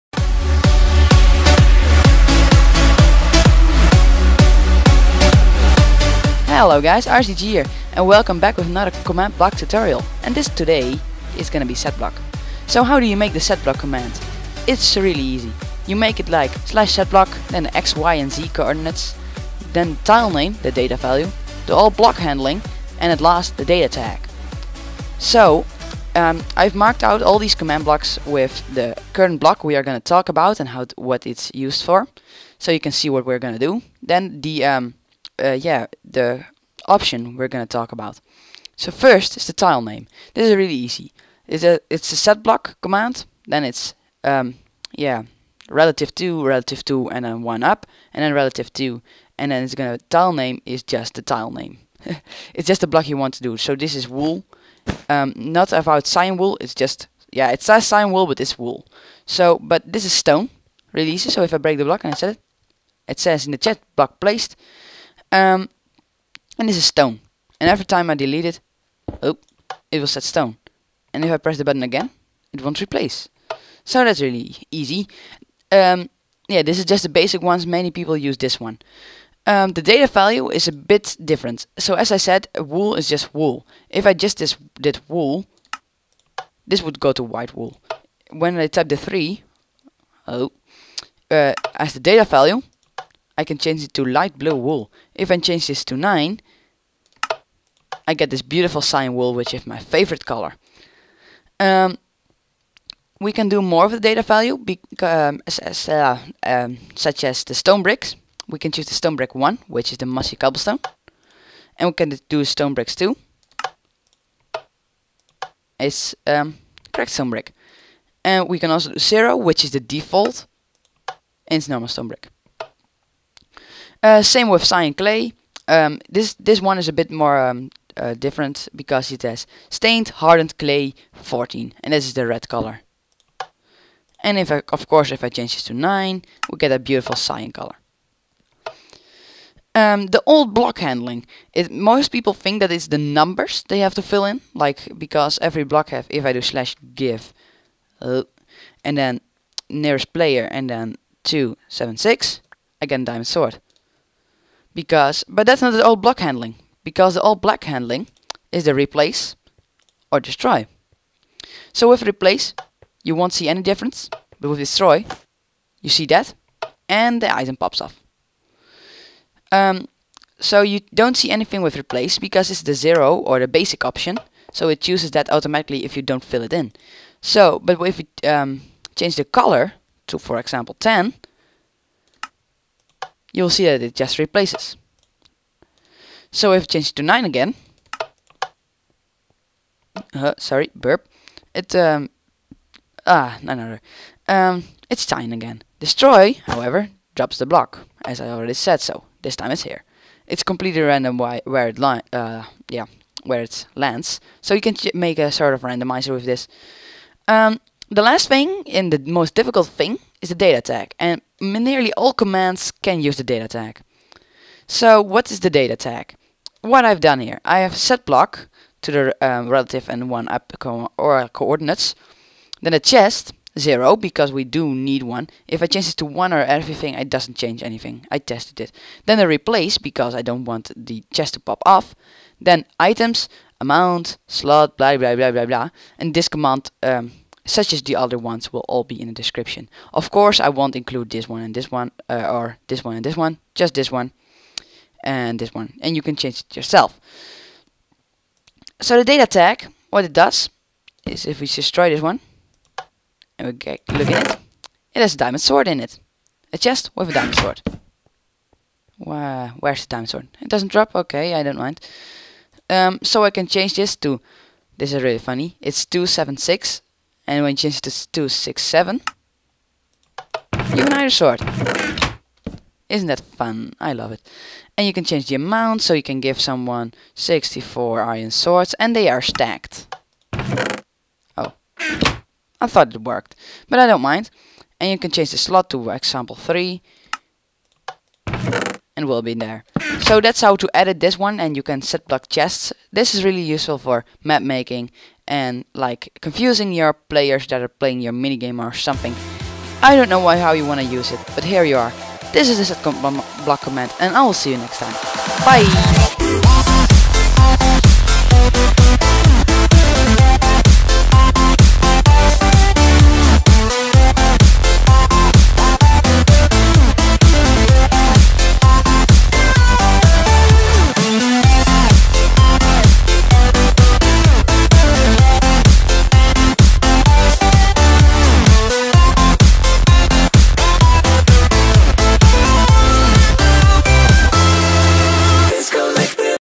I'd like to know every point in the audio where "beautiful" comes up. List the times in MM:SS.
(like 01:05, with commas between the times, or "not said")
01:38, 02:16.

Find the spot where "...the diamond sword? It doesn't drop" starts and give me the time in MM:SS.
04:19.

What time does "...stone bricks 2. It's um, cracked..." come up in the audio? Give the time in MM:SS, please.
01:52.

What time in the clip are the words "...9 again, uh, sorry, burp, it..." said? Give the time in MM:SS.
03:07.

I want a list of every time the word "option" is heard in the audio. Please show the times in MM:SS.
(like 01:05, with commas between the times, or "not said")
00:36, 02:53.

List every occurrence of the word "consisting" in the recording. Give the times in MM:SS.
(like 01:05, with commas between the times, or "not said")
not said.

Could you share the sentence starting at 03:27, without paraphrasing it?
Um, the last thing, and the most difficult thing, is the data tag.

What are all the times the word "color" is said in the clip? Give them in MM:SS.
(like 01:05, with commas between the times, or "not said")
01:40, 02:12, 02:17, 02:59.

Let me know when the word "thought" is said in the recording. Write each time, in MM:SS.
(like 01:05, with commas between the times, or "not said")
04:42.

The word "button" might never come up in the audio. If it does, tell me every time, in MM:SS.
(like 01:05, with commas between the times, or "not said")
01:11.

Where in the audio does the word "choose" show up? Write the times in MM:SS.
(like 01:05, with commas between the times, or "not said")
01:48, 02:54.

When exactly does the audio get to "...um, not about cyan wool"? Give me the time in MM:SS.
00:55.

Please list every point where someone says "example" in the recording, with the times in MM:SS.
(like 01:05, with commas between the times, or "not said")
03:00, 04:45.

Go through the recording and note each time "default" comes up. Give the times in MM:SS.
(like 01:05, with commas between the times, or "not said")
01:59.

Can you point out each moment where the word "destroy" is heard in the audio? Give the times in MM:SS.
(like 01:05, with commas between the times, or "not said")
02:40, 02:44, 03:15, 04:11.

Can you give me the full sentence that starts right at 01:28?
When I type the 3, oh, uh, as the data value, I can change it to light blue wool.